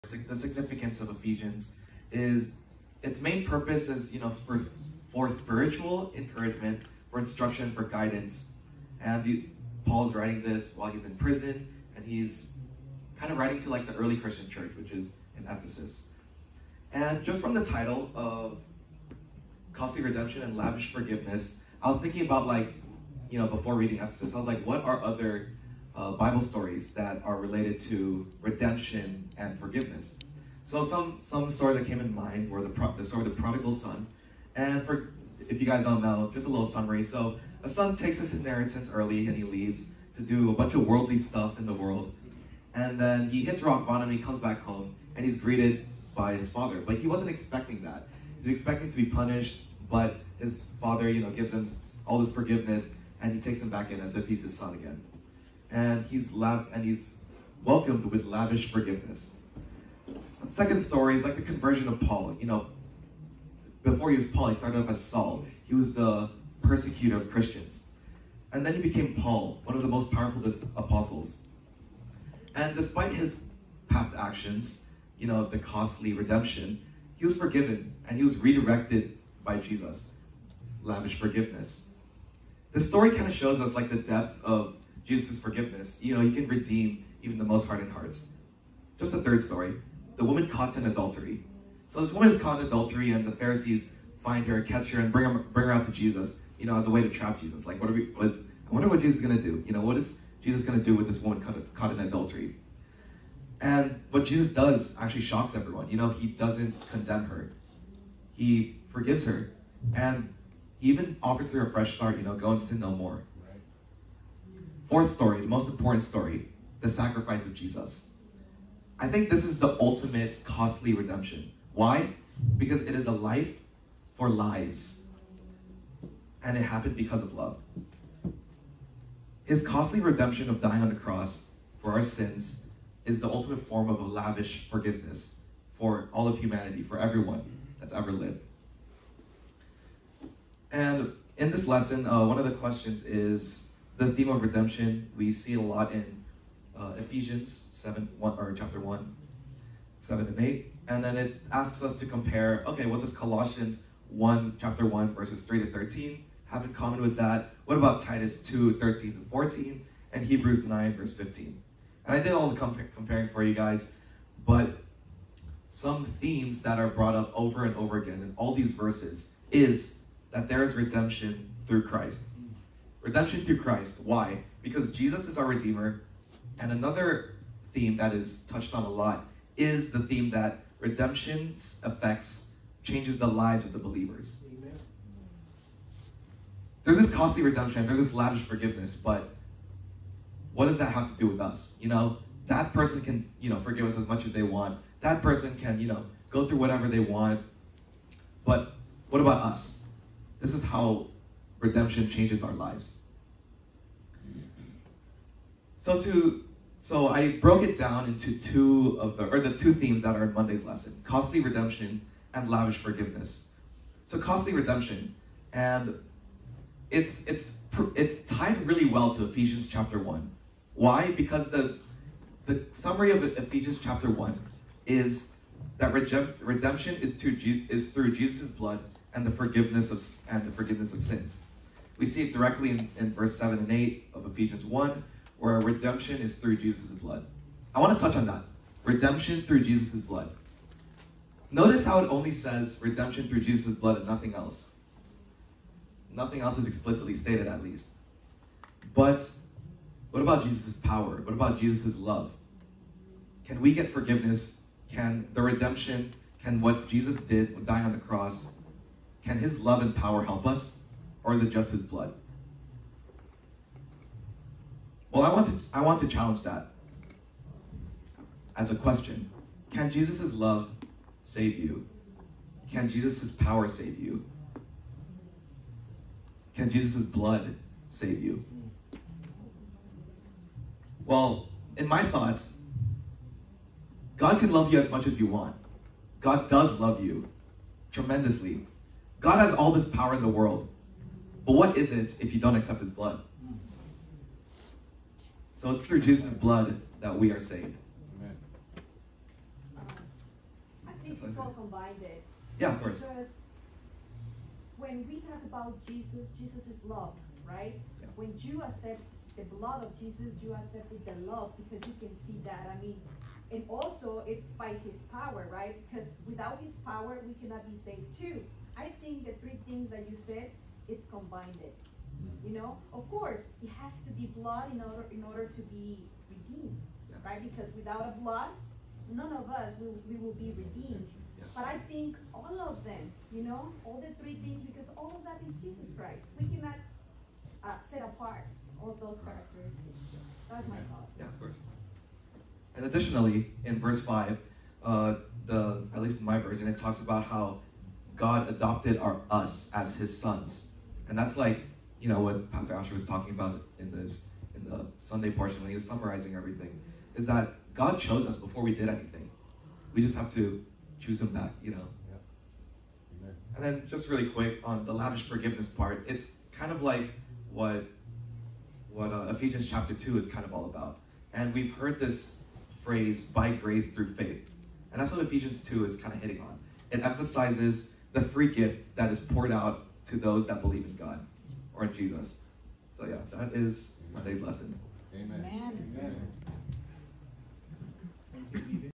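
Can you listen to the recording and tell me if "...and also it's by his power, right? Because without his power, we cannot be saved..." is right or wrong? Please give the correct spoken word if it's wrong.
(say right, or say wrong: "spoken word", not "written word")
right.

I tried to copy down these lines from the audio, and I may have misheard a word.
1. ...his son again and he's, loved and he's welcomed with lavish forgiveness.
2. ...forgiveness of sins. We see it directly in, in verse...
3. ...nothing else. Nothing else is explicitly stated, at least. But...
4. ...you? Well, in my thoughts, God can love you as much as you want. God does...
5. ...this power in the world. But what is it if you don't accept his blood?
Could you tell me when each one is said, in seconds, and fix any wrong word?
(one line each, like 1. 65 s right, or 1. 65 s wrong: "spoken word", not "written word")
1. 54 s right
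2. 230 s right
3. 244 s right
4. 278 s right
5. 289 s right.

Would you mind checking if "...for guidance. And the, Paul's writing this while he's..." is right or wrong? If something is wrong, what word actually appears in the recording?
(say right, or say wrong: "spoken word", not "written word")
right.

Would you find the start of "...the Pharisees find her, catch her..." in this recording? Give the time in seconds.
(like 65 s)
93 s.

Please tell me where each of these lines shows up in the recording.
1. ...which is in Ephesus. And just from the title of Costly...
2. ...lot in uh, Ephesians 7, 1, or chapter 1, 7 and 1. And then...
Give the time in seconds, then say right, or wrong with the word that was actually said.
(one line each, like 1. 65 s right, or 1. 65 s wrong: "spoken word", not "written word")
1. 14 s right
2. 145 s wrong: "8", not "1".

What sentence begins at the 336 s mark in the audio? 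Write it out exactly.
We cannot uh, set apart all those characteristics.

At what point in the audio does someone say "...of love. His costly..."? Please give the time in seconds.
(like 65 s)
127 s.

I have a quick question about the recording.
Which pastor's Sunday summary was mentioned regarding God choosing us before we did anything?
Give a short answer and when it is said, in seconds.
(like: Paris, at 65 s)
Pastor Asher, at 352 s.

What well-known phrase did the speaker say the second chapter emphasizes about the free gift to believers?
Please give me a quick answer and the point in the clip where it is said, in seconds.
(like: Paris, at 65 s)
by grace through faith, at 373 s.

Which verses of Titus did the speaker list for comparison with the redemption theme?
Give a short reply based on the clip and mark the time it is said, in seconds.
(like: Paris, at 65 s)
2:13-14, at 158 s.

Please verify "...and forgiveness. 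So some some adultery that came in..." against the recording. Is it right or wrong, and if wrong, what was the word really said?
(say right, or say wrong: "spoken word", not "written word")
wrong: "story", not "adultery".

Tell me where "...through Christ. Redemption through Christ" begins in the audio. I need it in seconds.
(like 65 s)
171 s.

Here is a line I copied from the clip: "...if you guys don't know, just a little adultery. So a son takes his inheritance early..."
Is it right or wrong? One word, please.
wrong.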